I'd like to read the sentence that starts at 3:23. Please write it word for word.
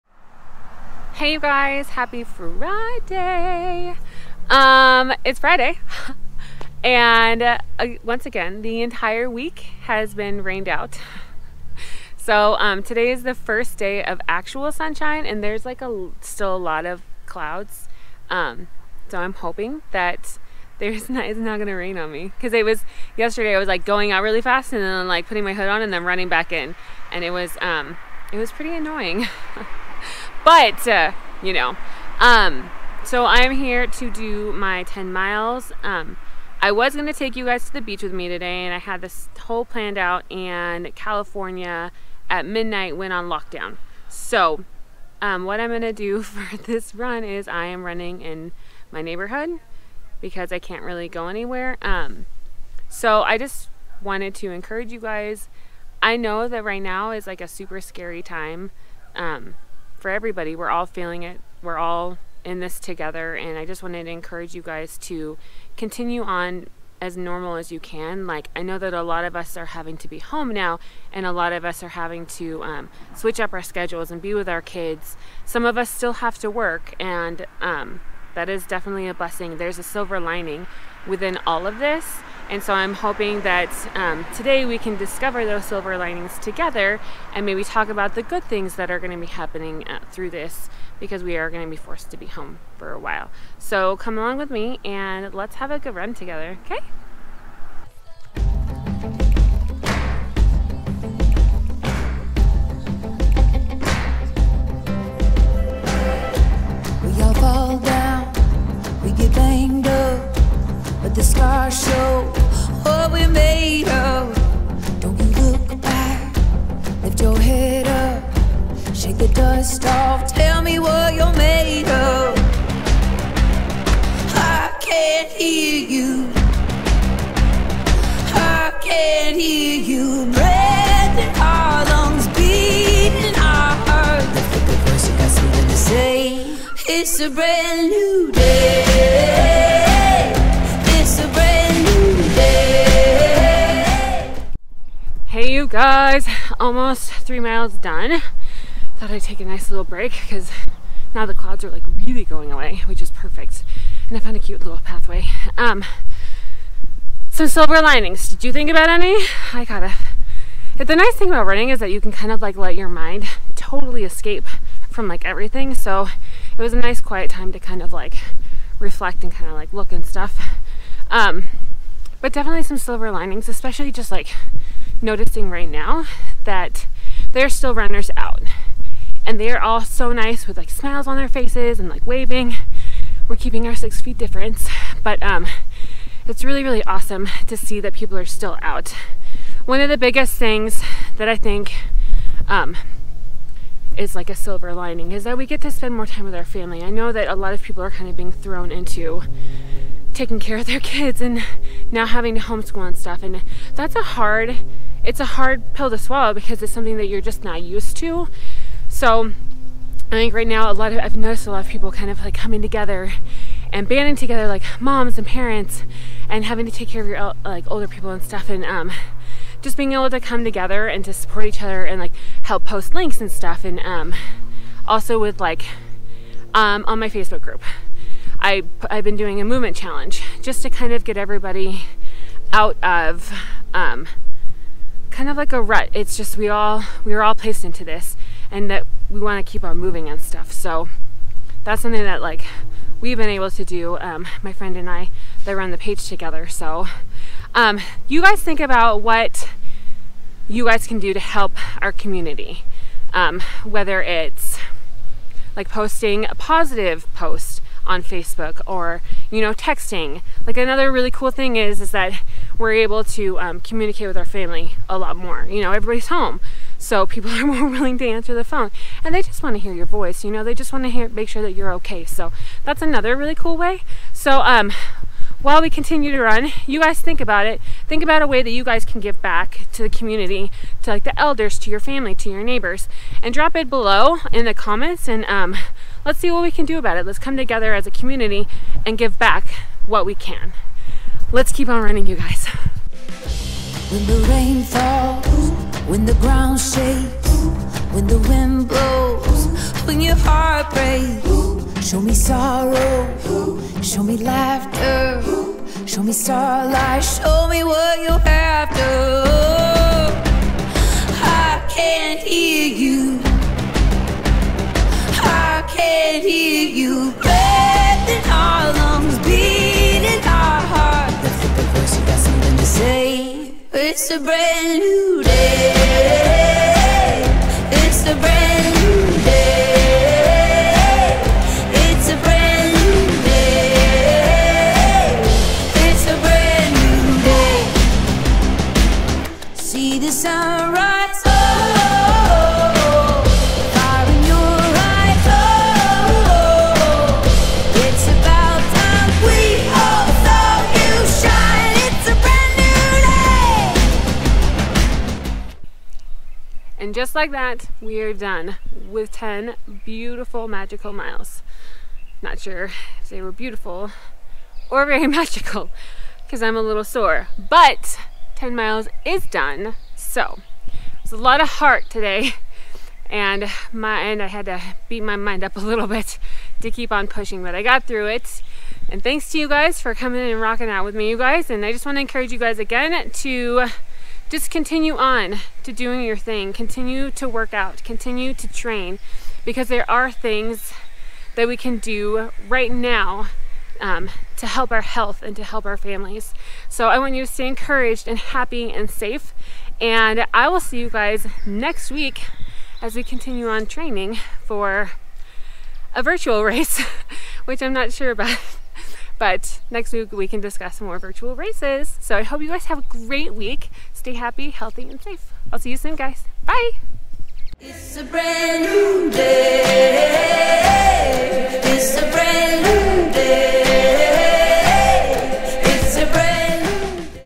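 And that's a hard it's a hard pill to swallow because it's something that you're just not used to.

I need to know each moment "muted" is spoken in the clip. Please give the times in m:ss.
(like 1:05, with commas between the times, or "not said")
not said.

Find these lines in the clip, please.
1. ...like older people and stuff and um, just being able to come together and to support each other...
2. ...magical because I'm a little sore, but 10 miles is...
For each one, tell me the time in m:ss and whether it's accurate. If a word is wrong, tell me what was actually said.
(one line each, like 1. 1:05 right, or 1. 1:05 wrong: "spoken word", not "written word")
1. 3:37 right
2. 6:05 right.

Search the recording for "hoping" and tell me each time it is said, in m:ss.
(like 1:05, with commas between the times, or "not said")
0:19, 1:22.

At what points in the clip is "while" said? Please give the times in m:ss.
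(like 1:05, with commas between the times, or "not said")
1:32, 4:35.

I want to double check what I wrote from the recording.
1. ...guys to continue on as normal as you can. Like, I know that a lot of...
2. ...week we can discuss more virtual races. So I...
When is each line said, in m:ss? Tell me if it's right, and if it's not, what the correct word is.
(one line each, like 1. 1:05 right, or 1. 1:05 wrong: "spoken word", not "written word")
1. 1:04 right
2. 6:49 right.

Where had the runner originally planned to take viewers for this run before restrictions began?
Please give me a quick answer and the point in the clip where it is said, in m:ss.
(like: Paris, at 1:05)
the beach, at 0:37.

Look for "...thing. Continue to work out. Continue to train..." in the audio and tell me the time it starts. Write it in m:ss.
6:26.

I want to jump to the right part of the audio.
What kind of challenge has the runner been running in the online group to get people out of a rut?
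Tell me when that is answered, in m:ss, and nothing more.
3:49.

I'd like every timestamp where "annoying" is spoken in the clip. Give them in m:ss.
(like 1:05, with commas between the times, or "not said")
0:28.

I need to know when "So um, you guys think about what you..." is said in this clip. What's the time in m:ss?
4:06.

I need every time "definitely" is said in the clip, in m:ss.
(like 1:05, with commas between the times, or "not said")
1:18, 2:52.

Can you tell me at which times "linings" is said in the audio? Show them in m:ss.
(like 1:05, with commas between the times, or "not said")
1:20, 1:25, 2:37, 2:53, 3:14.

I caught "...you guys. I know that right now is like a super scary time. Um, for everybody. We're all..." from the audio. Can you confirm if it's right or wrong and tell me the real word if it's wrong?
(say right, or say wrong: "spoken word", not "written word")
right.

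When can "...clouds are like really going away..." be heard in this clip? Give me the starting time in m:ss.
2:31.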